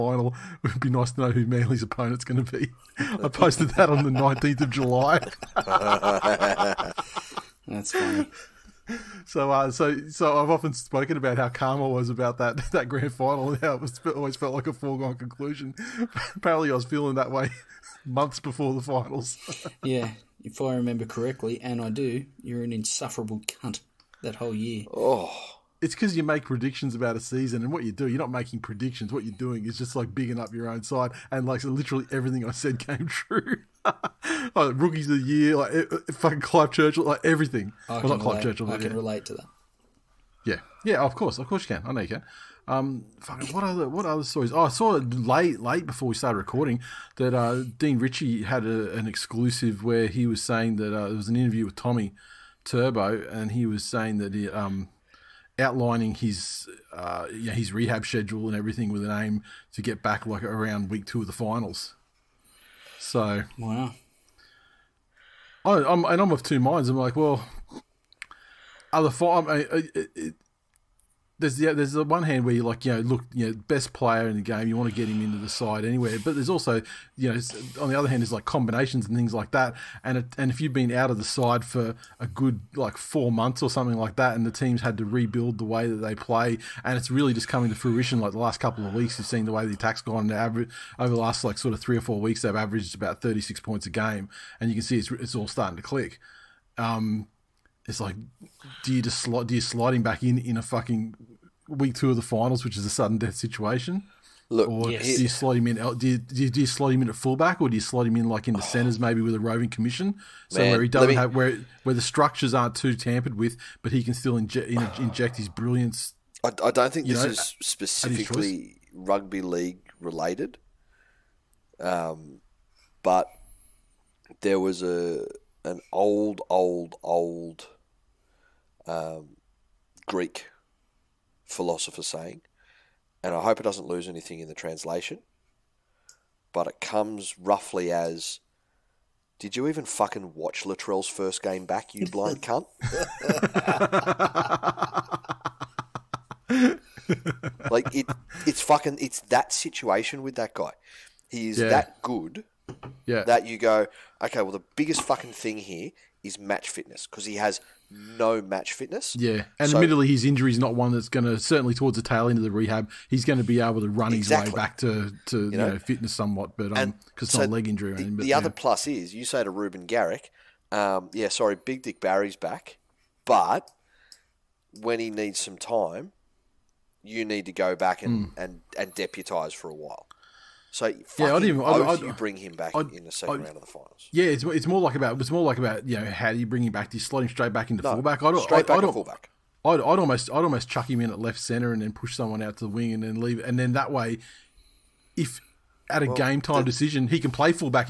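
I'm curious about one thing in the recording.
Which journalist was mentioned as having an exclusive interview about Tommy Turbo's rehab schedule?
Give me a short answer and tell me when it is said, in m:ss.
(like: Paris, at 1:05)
Dean Ritchie, at 0:47.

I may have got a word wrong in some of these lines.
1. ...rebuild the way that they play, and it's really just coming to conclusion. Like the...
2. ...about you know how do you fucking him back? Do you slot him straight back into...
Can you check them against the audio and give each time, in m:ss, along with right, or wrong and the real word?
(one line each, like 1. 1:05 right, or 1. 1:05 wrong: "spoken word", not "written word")
1. 1:25 wrong: "fruition", not "conclusion"
2. 3:05 wrong: "bring", not "fucking".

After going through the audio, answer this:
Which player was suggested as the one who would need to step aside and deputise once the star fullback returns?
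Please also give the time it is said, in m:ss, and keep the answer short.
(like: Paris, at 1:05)
Reuben Garrick, at 2:49.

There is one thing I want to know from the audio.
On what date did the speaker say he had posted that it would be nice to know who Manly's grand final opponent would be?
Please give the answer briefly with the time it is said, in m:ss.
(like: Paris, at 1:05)
19 July, at 0:04.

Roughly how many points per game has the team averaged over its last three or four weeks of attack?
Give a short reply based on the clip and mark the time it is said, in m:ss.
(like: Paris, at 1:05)
36, at 1:33.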